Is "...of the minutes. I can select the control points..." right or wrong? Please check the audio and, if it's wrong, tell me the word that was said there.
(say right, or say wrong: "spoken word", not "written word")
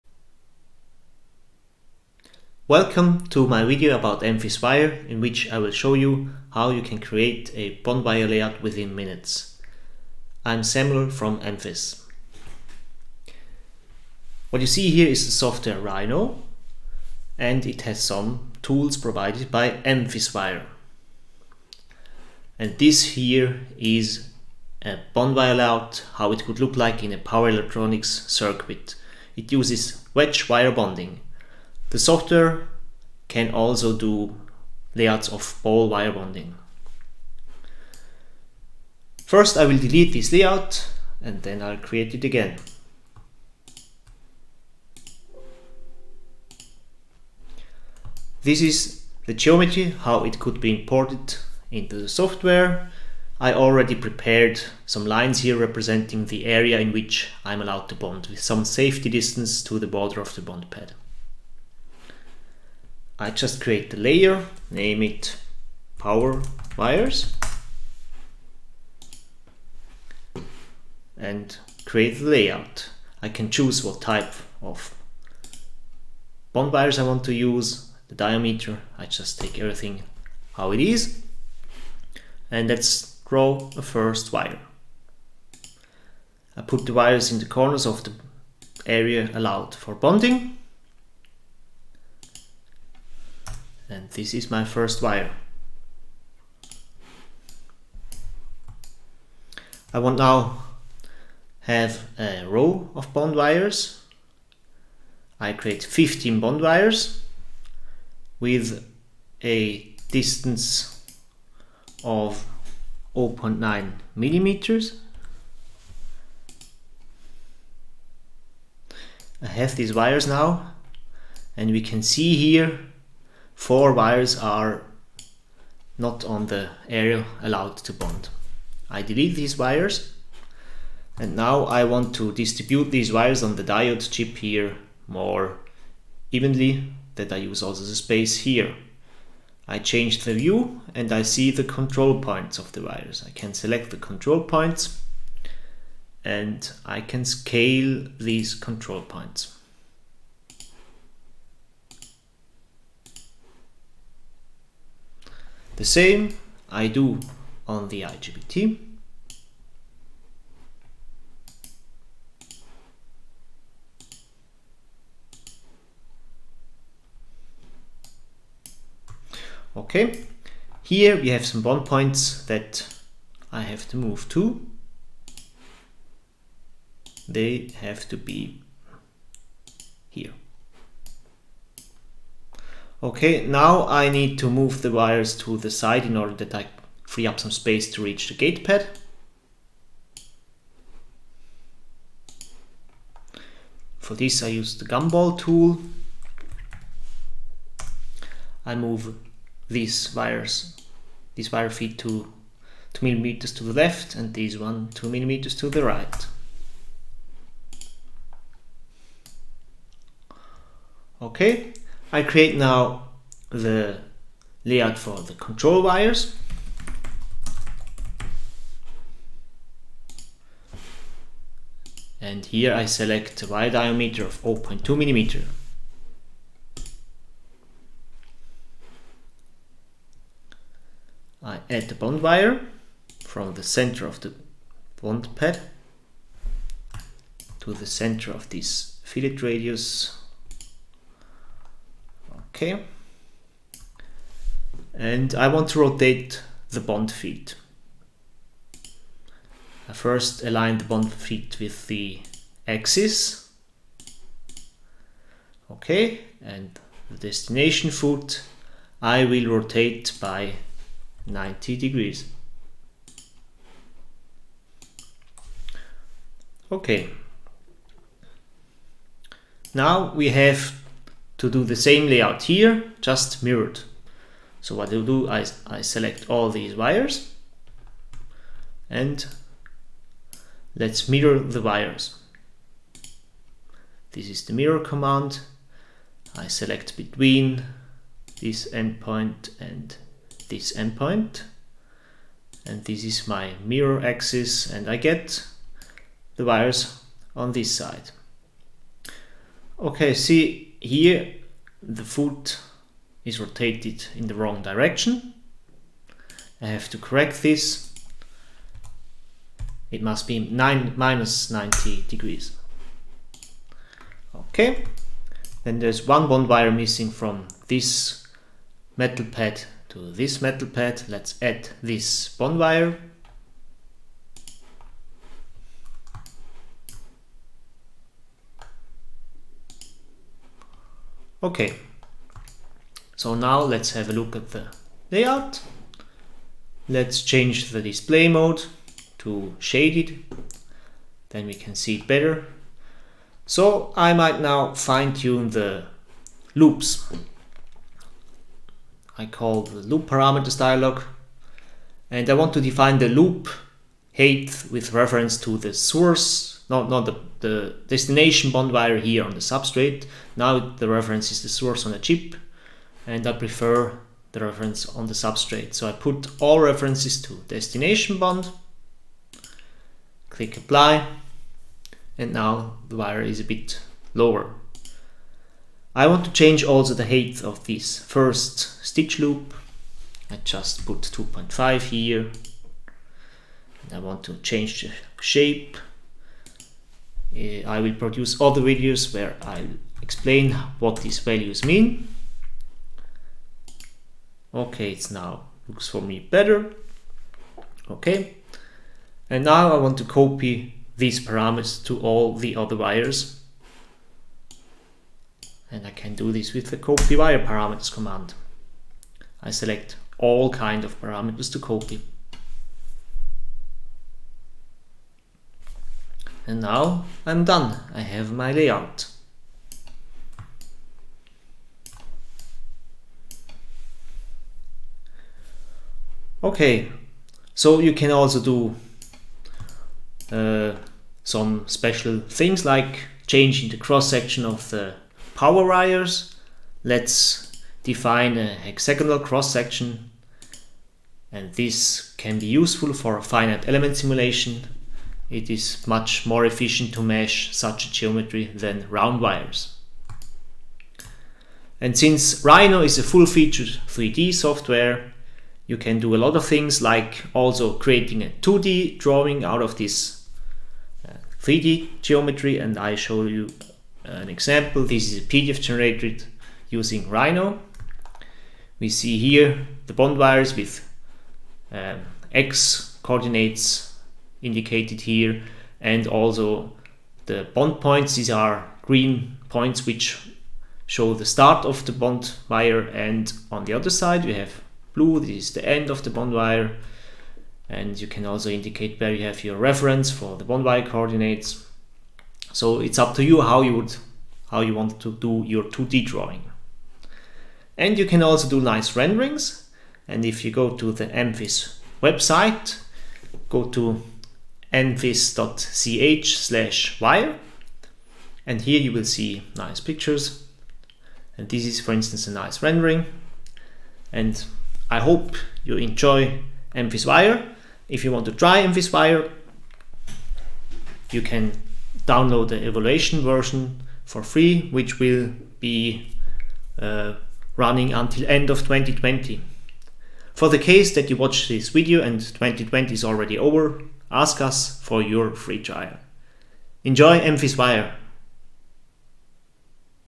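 wrong: "wires", not "minutes".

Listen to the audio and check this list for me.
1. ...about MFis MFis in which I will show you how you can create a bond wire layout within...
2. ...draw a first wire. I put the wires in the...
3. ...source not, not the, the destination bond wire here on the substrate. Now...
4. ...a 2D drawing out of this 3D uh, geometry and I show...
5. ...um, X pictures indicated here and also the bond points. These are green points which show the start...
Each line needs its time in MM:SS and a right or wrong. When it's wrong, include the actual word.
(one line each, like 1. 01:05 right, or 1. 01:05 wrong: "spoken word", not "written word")
1. 00:03 wrong: "Wire", not "MFis"
2. 01:23 right
3. 05:55 right
4. 07:38 right
5. 07:51 wrong: "coordinates", not "pictures".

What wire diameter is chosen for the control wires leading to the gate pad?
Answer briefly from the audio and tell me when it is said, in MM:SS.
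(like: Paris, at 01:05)
0.2 millimeter, at 03:44.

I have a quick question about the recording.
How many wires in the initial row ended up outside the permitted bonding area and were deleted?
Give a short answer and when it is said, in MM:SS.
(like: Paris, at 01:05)
4, at 02:03.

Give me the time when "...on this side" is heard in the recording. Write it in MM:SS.
04:57.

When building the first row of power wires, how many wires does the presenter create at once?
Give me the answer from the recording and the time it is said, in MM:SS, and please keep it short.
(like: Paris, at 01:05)
15, at 01:45.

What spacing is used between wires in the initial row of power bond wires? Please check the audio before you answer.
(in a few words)
0.9 millimeters.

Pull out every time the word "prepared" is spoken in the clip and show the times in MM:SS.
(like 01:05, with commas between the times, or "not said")
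00:53.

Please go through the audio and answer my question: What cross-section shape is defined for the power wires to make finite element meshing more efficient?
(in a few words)
hexagonal.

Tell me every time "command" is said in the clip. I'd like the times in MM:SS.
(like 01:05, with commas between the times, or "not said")
04:44, 06:47.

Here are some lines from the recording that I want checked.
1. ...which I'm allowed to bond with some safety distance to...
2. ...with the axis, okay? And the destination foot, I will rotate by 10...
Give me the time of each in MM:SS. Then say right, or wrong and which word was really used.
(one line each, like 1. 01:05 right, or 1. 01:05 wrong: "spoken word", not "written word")
1. 00:56 right
2. 04:11 wrong: "90", not "10".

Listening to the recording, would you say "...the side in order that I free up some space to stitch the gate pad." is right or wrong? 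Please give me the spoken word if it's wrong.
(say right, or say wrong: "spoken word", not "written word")
wrong: "reach", not "stitch".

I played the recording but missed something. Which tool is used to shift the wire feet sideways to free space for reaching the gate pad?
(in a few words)
gumball tool.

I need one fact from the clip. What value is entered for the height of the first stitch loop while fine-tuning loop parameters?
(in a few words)
2.5.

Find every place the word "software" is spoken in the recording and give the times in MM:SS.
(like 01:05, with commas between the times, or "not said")
00:15, 00:31, 00:52, 07:34.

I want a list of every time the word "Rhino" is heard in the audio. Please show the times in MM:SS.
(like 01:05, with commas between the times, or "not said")
00:15, 07:32, 07:47.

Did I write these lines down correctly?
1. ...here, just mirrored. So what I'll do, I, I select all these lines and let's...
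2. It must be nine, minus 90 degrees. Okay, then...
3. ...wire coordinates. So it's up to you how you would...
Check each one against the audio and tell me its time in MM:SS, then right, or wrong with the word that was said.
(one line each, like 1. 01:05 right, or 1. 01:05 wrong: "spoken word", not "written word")
1. 04:32 wrong: "wires", not "lines"
2. 05:09 right
3. 08:10 right.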